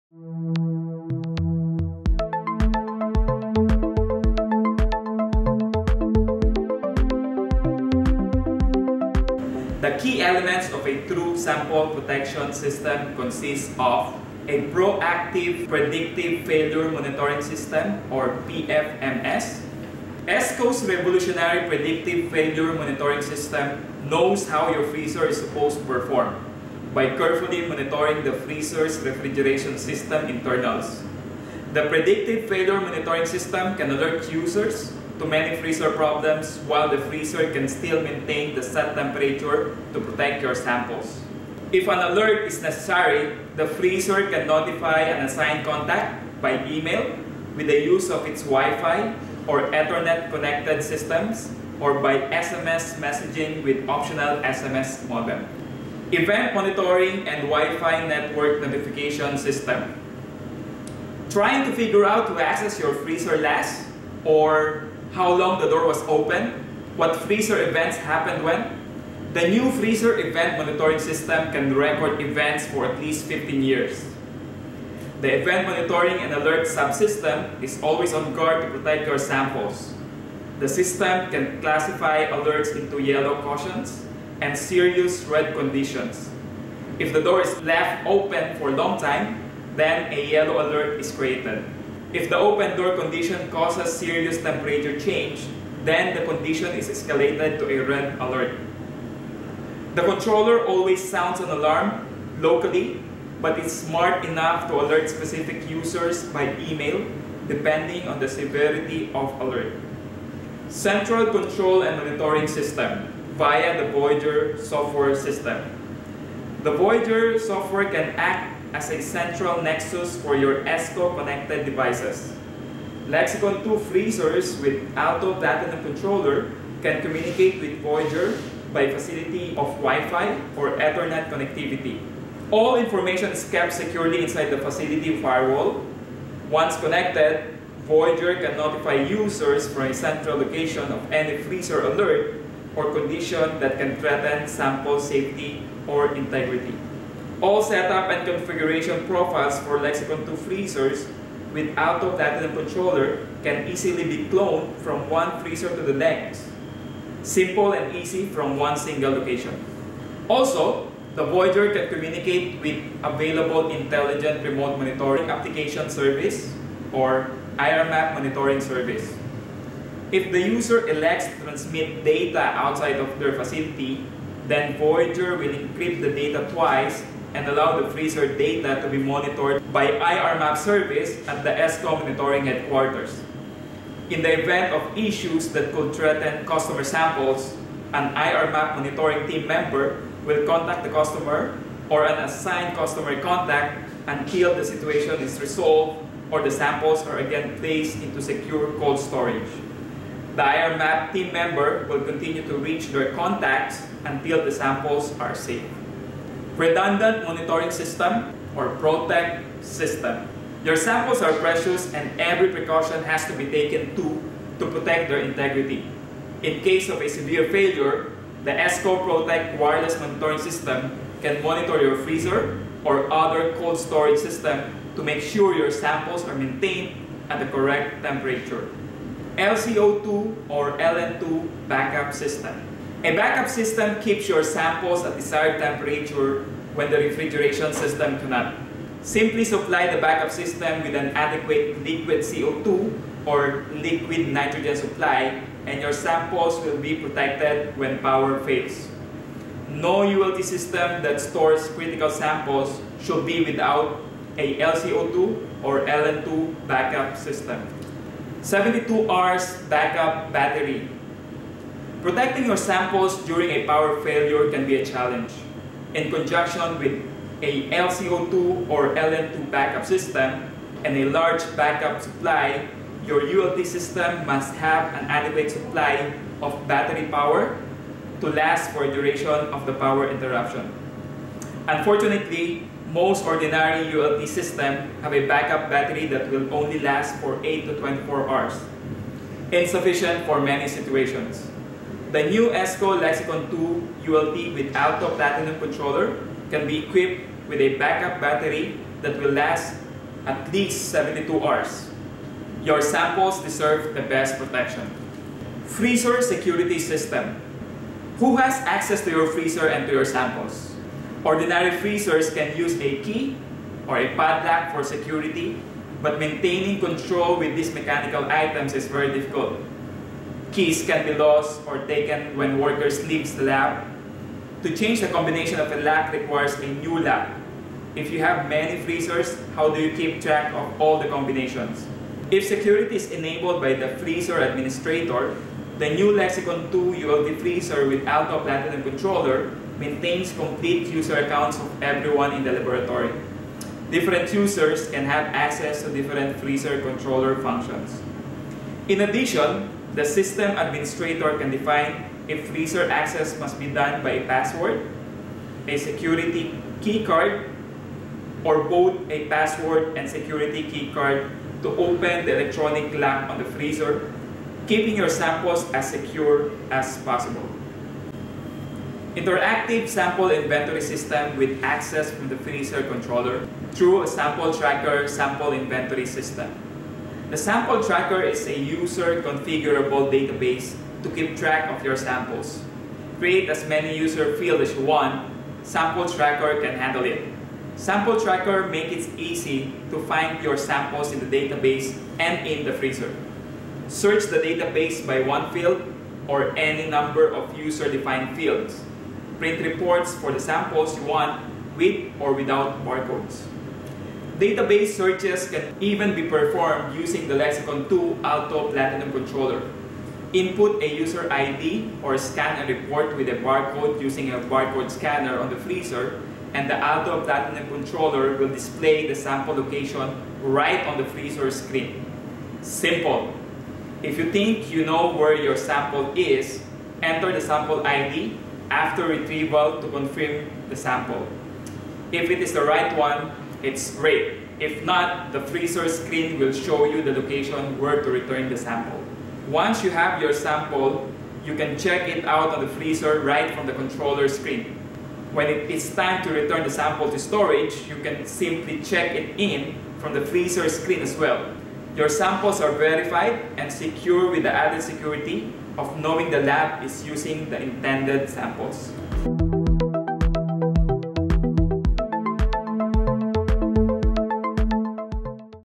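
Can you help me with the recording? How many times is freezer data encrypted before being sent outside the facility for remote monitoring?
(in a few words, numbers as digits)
twice.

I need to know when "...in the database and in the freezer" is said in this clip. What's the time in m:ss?
6:31.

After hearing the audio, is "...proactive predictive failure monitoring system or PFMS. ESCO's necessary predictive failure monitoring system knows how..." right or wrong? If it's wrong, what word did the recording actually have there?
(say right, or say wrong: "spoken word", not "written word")
wrong: "revolutionary", not "necessary".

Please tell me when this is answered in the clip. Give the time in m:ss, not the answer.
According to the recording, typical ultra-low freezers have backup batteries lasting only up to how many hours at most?
4:47.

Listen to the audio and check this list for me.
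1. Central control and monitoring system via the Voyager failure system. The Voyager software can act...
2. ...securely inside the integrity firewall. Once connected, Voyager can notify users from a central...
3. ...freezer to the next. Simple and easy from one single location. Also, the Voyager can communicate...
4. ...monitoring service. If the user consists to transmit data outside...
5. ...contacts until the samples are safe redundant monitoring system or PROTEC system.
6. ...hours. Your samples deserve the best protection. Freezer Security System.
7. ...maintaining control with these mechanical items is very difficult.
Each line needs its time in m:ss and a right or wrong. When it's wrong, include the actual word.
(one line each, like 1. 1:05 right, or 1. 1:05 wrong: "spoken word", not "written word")
1. 1:50 wrong: "software", not "failure"
2. 2:13 wrong: "facility", not "integrity"
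3. 2:35 right
4. 2:48 wrong: "elects", not "consists"
5. 3:23 right
6. 5:01 right
7. 5:16 right.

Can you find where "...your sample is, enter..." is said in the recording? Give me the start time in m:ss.
7:05.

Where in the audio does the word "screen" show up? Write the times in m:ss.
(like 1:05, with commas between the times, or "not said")
7:01, 7:15, 7:24, 7:30.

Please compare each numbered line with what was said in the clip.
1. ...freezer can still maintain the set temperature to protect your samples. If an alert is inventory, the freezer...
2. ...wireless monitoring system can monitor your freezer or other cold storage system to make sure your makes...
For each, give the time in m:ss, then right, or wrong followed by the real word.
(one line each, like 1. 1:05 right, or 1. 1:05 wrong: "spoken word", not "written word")
1. 0:37 wrong: "necessary", not "inventory"
2. 3:39 wrong: "samples", not "makes".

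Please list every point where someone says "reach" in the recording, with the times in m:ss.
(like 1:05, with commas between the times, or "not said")
3:22.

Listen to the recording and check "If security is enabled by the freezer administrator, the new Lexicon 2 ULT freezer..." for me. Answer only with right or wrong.
right.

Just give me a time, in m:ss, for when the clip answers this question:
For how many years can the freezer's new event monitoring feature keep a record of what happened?
1:13.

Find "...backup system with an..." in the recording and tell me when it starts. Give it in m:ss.
3:59.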